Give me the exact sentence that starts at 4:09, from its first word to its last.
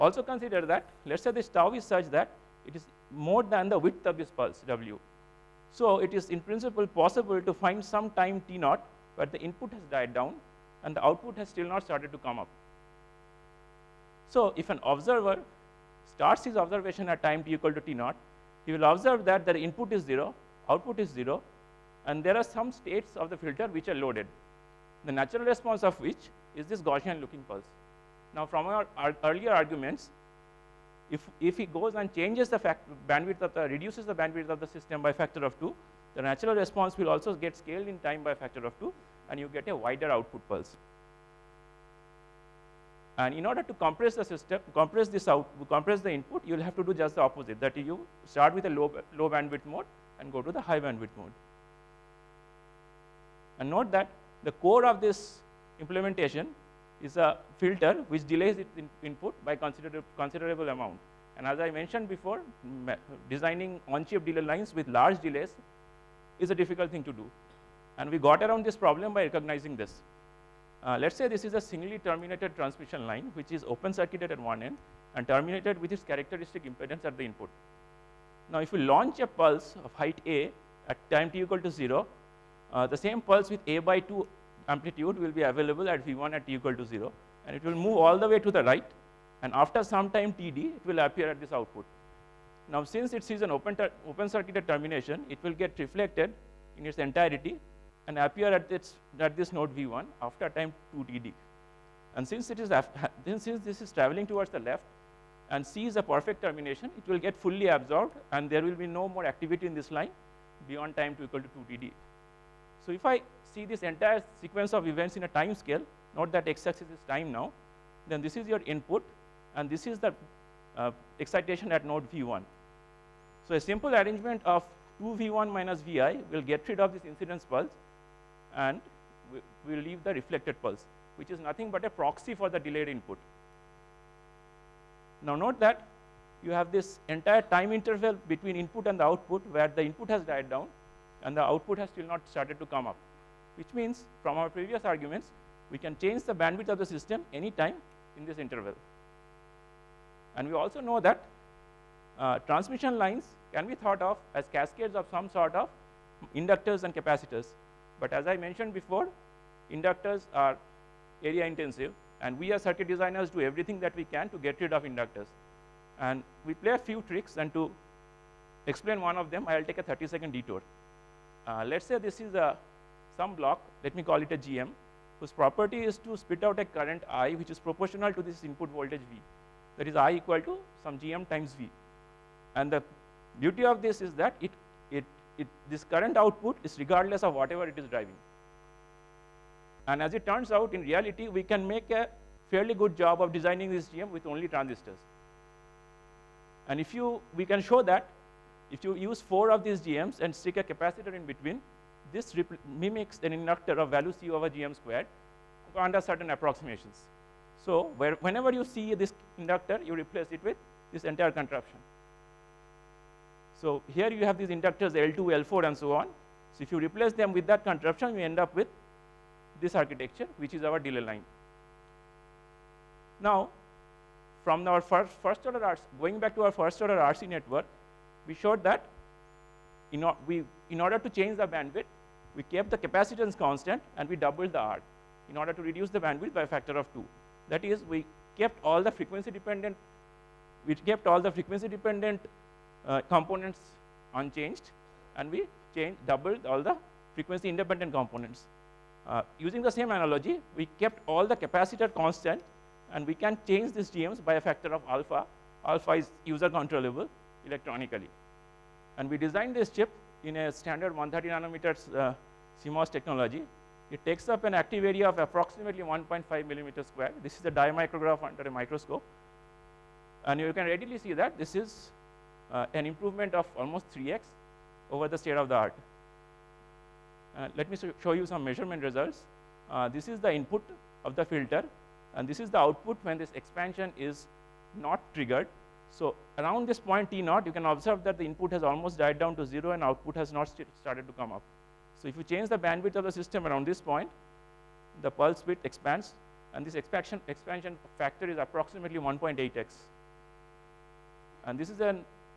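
Uh, using the same analogy, we kept all the capacitor constant and we can change these GMs by a factor of alpha.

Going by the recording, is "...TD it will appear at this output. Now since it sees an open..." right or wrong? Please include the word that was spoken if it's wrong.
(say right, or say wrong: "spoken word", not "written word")
right.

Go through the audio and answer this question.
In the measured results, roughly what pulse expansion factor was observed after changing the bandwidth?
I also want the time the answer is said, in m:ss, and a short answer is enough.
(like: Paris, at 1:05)
1.8x, at 4:58.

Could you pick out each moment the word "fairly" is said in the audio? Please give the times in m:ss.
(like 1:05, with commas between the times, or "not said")
3:12.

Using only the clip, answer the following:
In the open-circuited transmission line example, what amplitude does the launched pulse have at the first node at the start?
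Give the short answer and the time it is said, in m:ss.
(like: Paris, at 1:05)
A/2, at 1:23.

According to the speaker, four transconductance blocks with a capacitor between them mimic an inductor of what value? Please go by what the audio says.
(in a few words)
C over GM squared.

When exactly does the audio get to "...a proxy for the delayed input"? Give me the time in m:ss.
2:11.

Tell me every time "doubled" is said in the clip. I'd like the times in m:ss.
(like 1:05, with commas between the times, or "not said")
3:54, 4:06.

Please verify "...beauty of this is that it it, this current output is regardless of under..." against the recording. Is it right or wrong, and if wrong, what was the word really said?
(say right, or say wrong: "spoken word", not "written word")
wrong: "whatever", not "under".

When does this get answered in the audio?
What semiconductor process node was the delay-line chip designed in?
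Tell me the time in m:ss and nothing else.
4:20.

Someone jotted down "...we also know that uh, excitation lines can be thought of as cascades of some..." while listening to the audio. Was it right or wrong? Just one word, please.
wrong.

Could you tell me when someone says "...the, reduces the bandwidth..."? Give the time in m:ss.
0:33.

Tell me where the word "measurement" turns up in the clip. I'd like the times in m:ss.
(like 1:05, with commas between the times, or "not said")
4:38.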